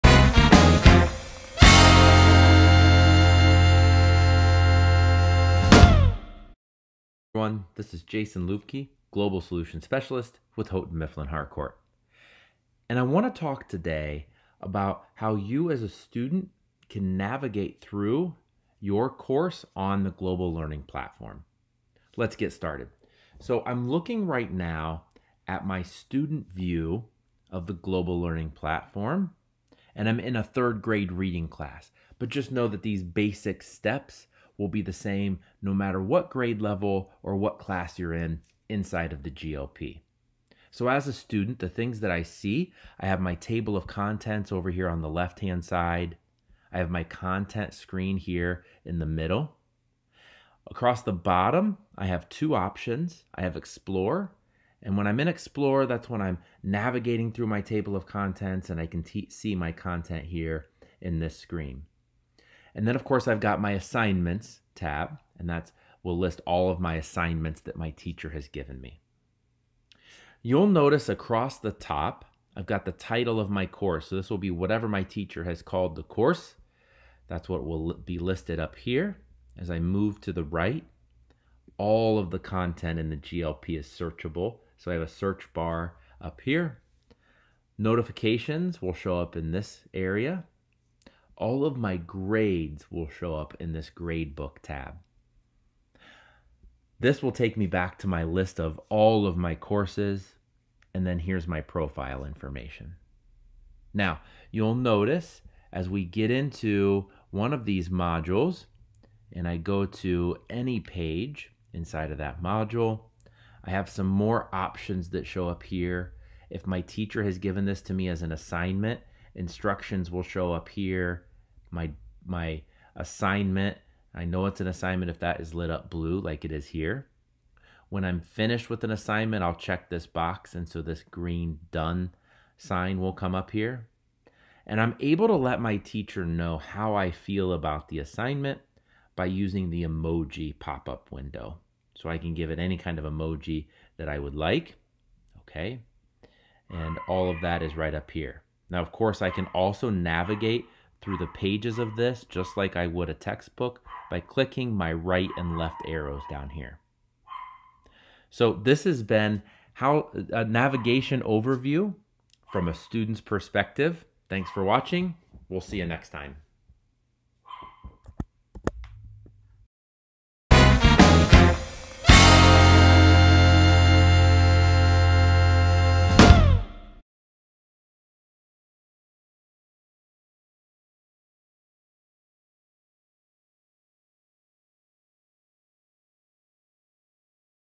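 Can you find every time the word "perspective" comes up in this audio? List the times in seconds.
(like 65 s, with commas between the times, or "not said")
163 s.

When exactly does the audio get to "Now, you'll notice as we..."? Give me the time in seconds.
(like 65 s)
103 s.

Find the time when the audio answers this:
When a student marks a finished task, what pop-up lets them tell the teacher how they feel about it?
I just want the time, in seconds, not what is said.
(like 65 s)
139 s.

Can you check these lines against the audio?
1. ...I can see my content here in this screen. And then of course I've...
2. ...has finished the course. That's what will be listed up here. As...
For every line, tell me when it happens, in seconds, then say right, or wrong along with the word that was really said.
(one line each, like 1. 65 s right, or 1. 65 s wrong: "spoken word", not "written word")
1. 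58 s right
2. 75 s wrong: "called", not "finished".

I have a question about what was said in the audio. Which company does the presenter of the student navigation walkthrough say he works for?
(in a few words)
Houghton Mifflin Harcourt.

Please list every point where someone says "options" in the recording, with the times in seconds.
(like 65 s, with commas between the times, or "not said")
52 s, 114 s.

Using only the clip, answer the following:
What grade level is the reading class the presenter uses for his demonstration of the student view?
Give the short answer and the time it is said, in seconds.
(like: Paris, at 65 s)
third grade, at 30 s.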